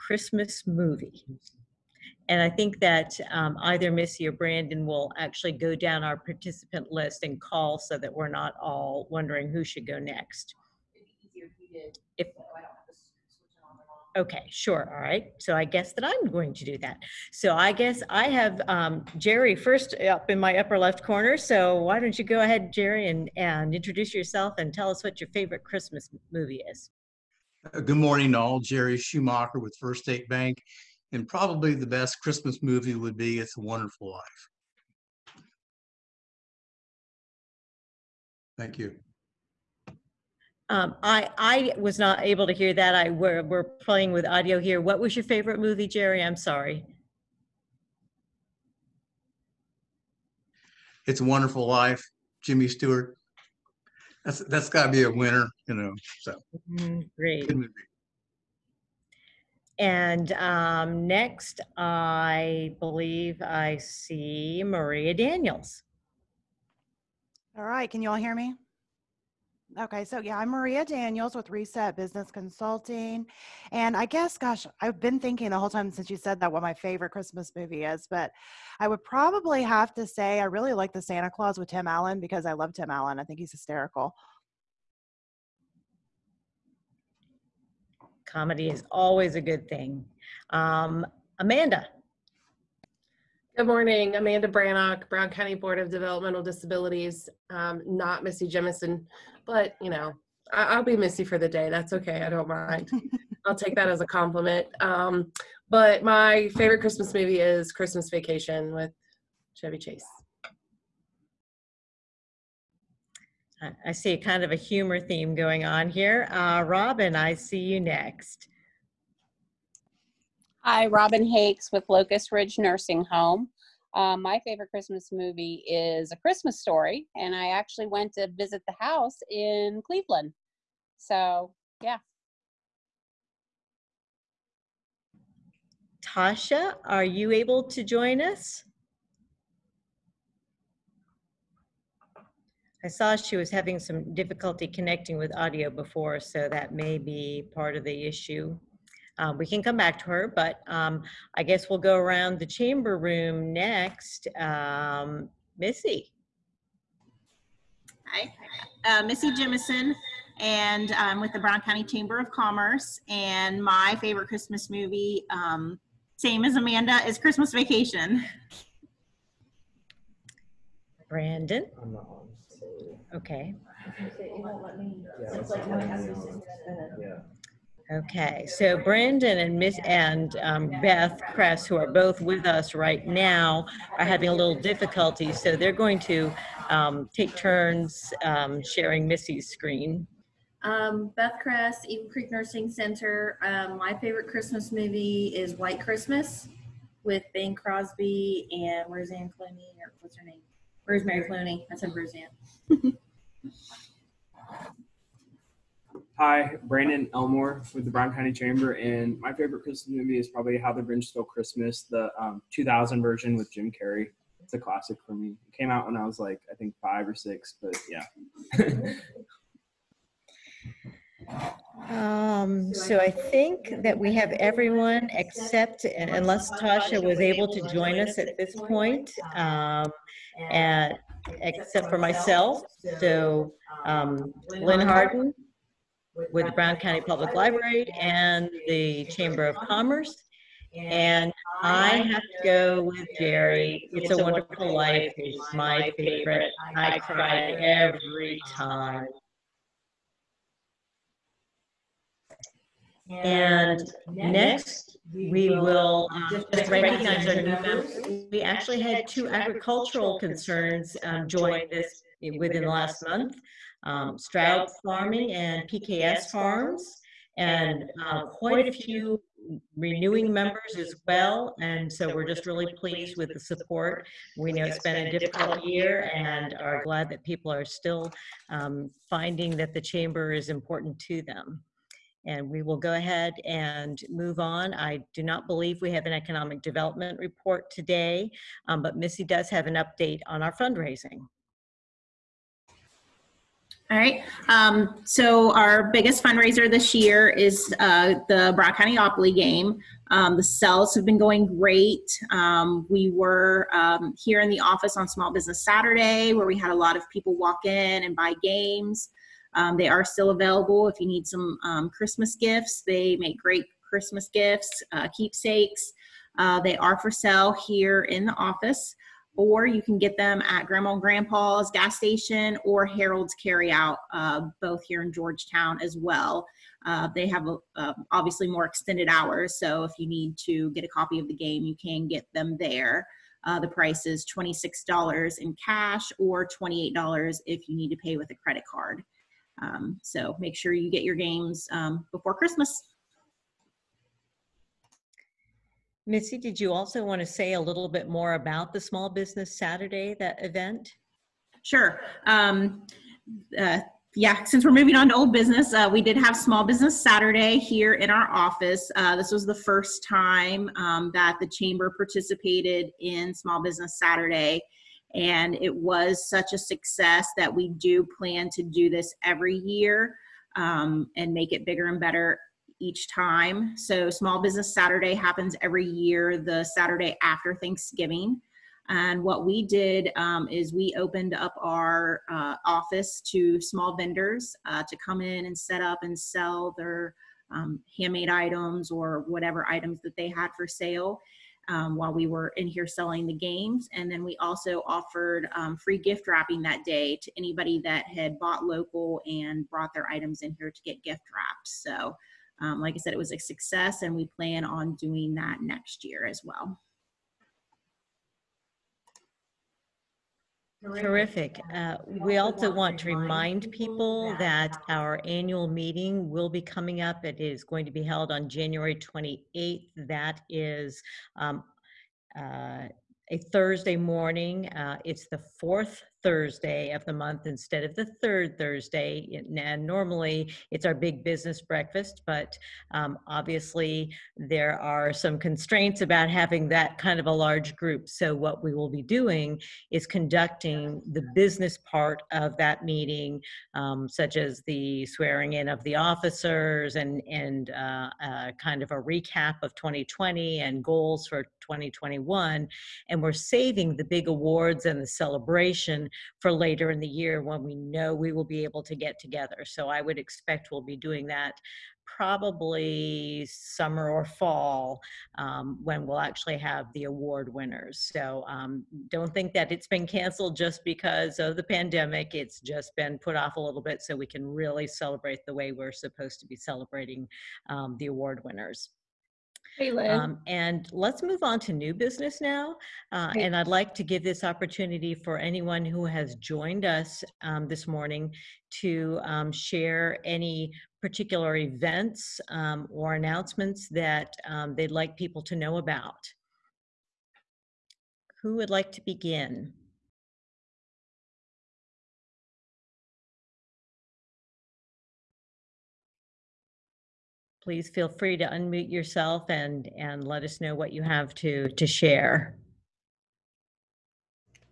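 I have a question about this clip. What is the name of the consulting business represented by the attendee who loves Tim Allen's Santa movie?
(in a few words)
Reset Business Consulting.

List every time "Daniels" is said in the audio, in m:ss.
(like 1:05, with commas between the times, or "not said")
1:05, 1:10.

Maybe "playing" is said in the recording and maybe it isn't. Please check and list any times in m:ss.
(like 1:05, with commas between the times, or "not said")
0:43.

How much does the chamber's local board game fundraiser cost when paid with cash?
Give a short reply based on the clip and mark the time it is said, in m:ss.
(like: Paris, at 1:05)
$26, at 5:34.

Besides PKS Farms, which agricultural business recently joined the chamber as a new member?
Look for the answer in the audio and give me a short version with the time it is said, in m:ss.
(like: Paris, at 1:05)
Stroud Farming, at 4:24.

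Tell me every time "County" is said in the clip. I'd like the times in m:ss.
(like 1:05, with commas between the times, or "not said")
1:35, 2:41, 3:28, 3:56, 4:58.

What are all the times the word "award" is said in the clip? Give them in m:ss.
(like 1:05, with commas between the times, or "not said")
7:34, 7:47, 7:58.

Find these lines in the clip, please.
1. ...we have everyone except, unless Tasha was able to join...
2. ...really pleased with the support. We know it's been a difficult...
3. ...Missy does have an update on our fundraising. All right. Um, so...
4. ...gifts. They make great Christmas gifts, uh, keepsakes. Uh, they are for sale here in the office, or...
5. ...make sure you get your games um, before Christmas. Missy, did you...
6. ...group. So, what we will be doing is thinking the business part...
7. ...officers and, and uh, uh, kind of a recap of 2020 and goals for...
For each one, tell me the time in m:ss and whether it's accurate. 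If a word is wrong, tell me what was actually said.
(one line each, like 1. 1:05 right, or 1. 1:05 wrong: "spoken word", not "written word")
1. 3:43 right
2. 4:32 right
3. 4:48 right
4. 5:12 right
5. 5:40 right
6. 7:17 wrong: "conducting", not "thinking"
7. 7:25 right.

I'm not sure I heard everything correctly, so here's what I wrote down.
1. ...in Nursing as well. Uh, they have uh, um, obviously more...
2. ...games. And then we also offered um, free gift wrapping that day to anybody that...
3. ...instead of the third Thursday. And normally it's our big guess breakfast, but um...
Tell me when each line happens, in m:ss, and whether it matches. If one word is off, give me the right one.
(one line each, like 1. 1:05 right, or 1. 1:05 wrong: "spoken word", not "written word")
1. 5:25 wrong: "Georgetown", not "Nursing"
2. 6:33 right
3. 7:07 wrong: "business", not "guess".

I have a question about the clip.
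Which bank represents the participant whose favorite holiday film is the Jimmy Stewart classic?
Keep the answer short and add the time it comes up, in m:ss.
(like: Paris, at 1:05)
First State Bank, at 0:29.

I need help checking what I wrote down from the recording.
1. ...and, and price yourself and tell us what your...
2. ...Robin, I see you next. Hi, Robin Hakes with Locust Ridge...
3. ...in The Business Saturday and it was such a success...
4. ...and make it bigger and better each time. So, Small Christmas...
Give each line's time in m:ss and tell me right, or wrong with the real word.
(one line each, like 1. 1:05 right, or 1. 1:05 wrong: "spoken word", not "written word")
1. 0:23 wrong: "introduce", not "price"
2. 1:56 right
3. 6:02 wrong: "Small", not "The"
4. 6:11 wrong: "Business", not "Christmas".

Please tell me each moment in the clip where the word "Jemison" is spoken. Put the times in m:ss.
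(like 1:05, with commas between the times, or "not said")
1:38, 2:39.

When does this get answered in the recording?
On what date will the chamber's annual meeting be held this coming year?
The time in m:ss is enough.
6:58.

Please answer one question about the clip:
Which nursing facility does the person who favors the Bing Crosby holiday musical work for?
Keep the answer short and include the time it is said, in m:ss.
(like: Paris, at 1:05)
Eagle Creek Nursing Center, at 3:11.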